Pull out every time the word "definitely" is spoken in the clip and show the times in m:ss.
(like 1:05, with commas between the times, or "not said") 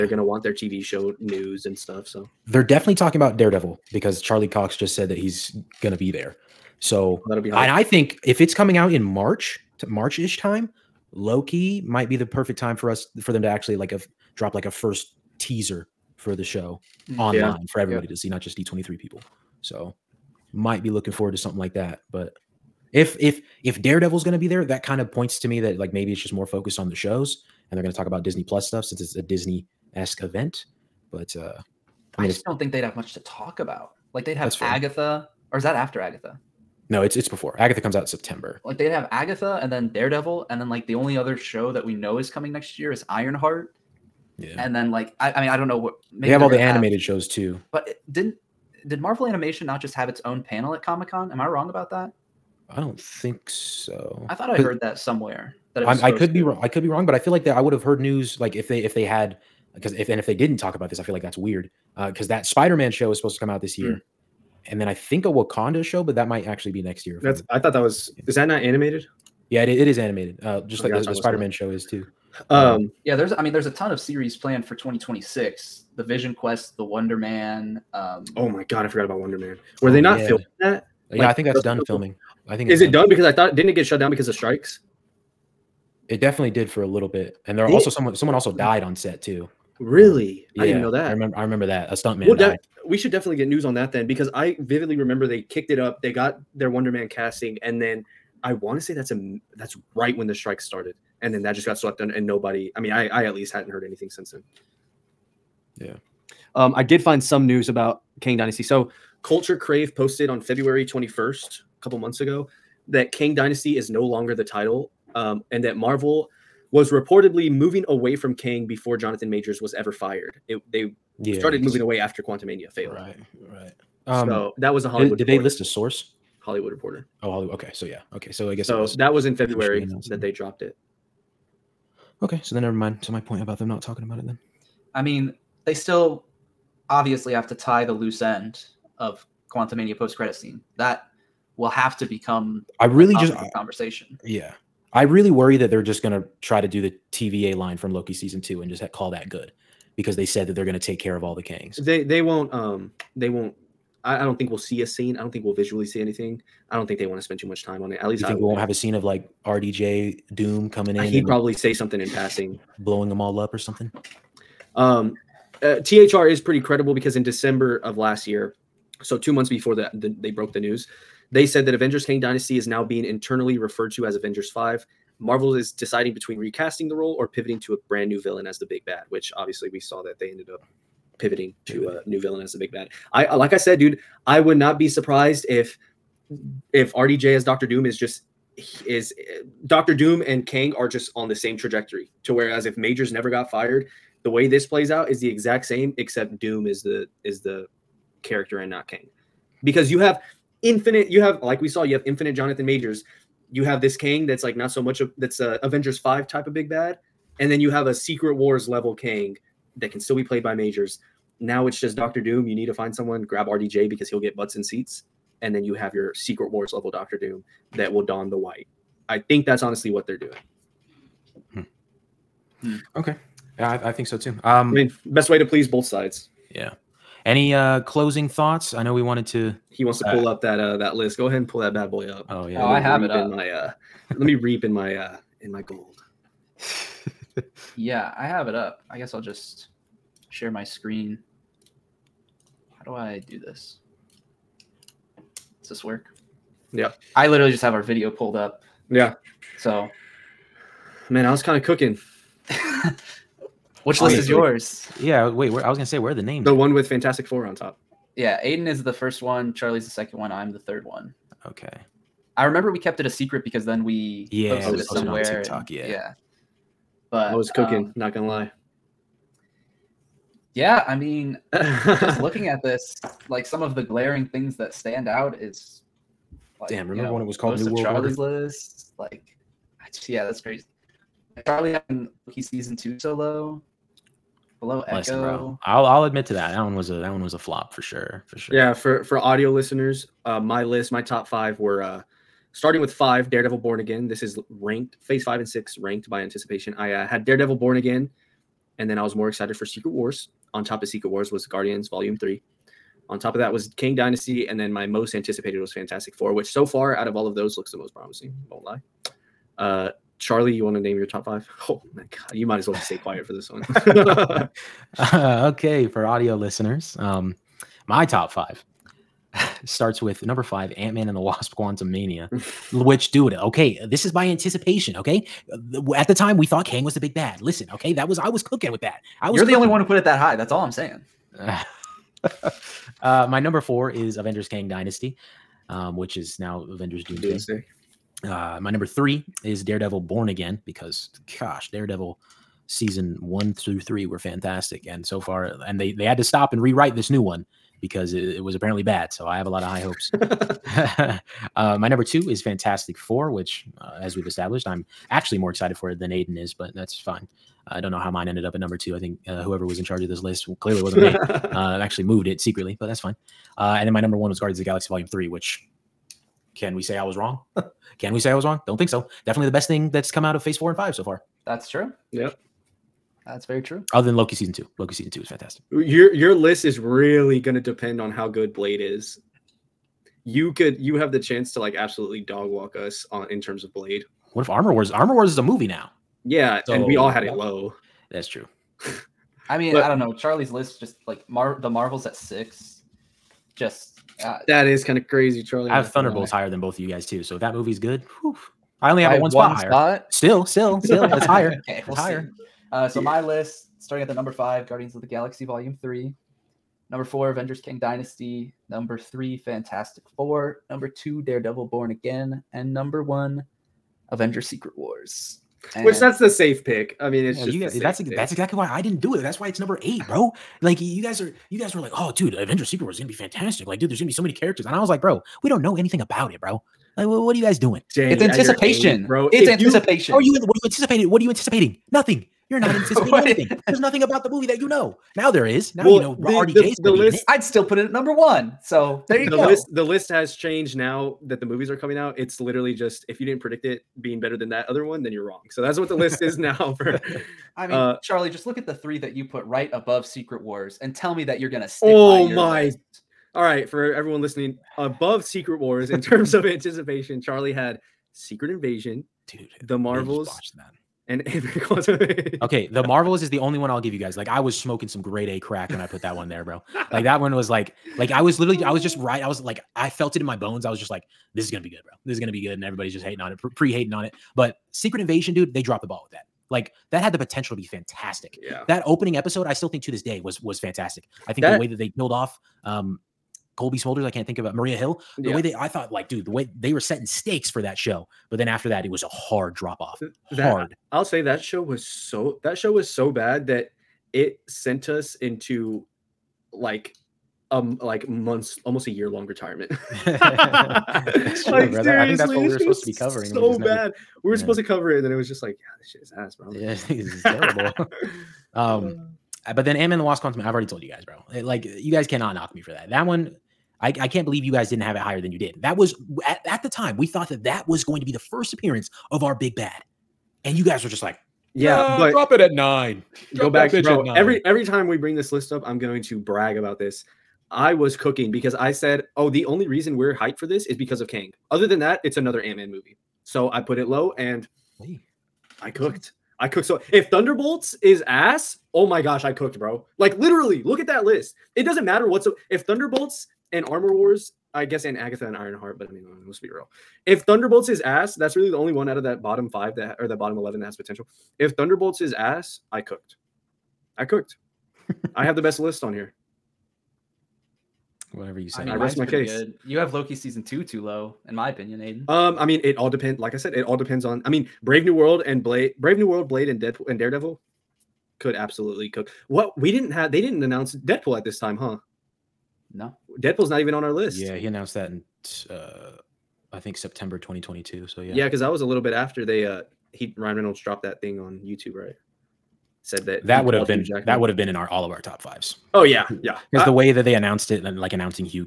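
0:02, 1:26, 1:33, 6:09.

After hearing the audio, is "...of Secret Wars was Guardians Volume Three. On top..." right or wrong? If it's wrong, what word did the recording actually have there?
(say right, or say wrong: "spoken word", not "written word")
right.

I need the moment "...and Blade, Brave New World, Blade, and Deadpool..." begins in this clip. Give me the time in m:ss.
9:25.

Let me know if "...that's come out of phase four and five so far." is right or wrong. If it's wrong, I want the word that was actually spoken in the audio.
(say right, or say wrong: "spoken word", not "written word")
right.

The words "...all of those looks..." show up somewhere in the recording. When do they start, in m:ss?
5:07.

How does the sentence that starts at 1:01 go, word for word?
Because uh, that Spider-Man show is supposed to come out this year, mm.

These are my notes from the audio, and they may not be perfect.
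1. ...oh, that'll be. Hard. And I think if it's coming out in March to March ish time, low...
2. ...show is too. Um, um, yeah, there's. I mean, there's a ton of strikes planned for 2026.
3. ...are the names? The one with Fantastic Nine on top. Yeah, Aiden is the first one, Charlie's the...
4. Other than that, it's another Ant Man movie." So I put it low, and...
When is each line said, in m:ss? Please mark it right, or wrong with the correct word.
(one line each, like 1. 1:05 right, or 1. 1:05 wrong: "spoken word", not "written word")
1. 0:07 right
2. 1:11 wrong: "series", not "strikes"
3. 4:16 wrong: "Four", not "Nine"
4. 8:51 right.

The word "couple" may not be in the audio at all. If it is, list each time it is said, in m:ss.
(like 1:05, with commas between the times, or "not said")
1:51.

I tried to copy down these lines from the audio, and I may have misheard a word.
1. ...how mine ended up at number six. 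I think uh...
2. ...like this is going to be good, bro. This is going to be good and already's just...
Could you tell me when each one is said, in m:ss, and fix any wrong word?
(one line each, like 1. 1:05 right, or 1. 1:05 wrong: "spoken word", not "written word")
1. 5:57 wrong: "two", not "six"
2. 7:50 wrong: "everybody", not "already".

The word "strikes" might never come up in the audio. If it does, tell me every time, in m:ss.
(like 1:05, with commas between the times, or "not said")
1:24, 1:40.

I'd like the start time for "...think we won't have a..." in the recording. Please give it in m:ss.
2:38.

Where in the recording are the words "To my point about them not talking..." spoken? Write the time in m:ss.
2:13.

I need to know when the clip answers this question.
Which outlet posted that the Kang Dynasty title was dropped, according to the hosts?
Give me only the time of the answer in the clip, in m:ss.
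1:49.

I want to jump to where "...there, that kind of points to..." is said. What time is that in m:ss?
0:24.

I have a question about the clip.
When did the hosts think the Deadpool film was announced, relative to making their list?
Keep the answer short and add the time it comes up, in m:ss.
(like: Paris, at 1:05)
September 2022, at 9:36.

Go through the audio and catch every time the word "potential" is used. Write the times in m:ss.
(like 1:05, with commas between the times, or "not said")
7:57, 9:10.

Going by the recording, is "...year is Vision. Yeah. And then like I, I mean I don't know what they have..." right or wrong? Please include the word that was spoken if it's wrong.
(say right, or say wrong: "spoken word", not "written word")
wrong: "Ironheart", not "Vision".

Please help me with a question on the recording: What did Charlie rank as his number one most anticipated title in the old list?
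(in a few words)
Guardians of the Galaxy Volume 3.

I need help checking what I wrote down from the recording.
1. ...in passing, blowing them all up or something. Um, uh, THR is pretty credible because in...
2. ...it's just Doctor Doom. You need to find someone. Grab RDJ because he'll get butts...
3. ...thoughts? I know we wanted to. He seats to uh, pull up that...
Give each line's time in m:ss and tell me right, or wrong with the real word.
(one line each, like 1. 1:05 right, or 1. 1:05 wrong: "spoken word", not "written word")
1. 2:42 right
2. 3:31 right
3. 3:48 wrong: "wants", not "seats".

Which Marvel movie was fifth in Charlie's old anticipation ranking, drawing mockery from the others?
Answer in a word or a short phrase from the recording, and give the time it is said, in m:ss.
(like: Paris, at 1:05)
Ant Man and the Wasp Quantumania, at 5:20.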